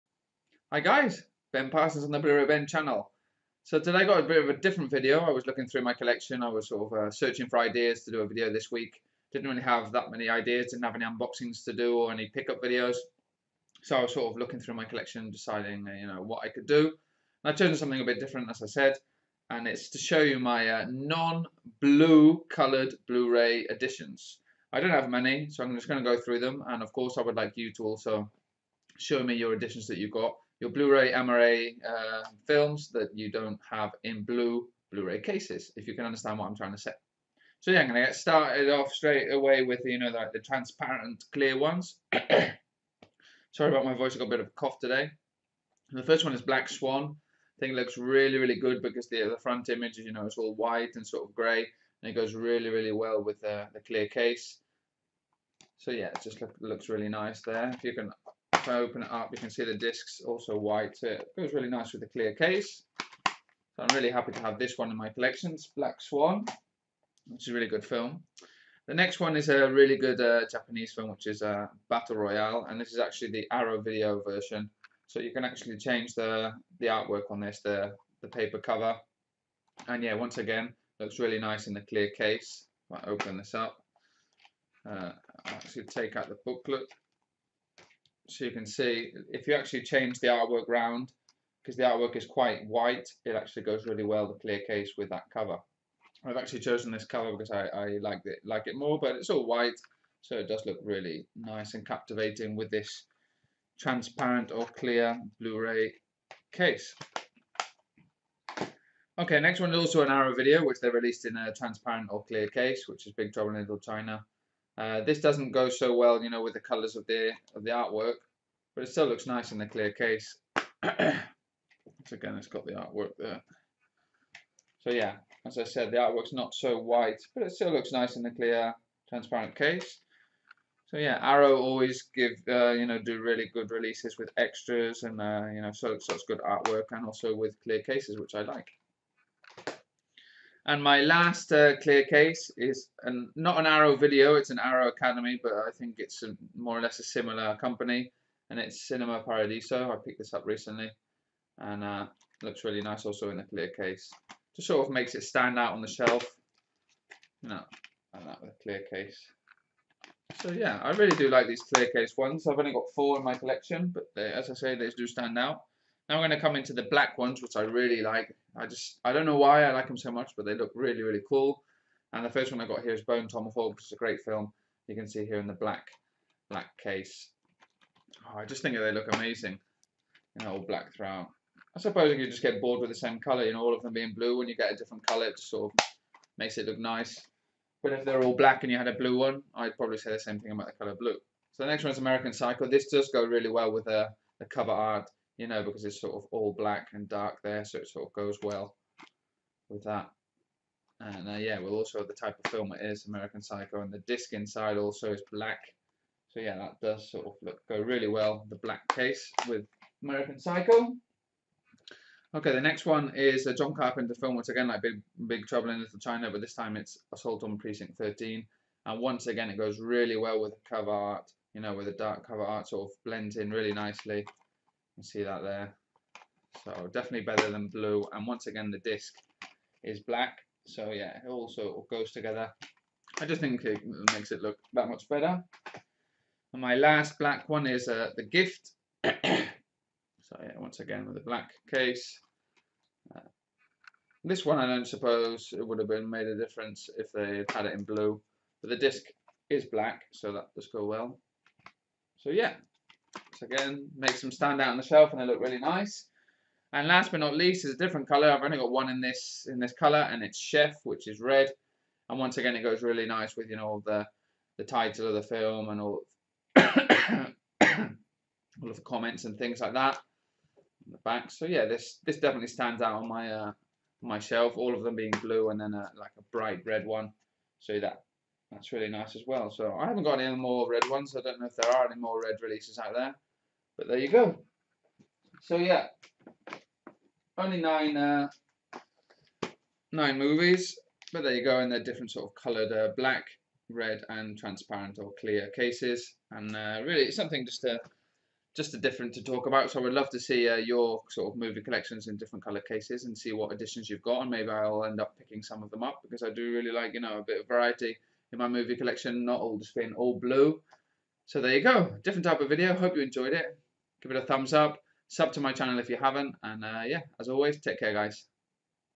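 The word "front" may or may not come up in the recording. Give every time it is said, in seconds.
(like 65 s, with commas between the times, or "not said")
49 s.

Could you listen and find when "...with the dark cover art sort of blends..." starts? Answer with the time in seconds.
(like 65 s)
221 s.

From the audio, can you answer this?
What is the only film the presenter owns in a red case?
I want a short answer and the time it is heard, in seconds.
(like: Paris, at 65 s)
Chef, at 260 s.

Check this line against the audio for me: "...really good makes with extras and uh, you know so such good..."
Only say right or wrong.
wrong.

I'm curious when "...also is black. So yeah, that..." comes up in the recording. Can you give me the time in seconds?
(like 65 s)
204 s.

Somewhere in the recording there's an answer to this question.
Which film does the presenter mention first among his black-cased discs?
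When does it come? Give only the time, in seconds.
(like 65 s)
172 s.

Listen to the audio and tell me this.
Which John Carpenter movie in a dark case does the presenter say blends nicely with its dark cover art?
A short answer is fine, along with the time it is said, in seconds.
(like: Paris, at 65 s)
Assault on Precinct 13, at 217 s.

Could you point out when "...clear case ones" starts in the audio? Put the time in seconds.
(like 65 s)
161 s.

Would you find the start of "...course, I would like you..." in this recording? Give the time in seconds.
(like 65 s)
26 s.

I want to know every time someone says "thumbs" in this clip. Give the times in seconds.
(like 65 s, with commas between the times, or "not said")
314 s.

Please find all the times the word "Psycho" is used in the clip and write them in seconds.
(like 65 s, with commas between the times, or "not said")
192 s, 203 s, 210 s.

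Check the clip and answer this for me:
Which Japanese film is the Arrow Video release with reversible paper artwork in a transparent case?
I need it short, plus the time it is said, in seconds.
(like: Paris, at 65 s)
Battle Royale, at 71 s.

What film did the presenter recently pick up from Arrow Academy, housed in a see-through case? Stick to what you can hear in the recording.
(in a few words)
Cinema Paradiso.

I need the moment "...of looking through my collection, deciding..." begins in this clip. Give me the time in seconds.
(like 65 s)
14 s.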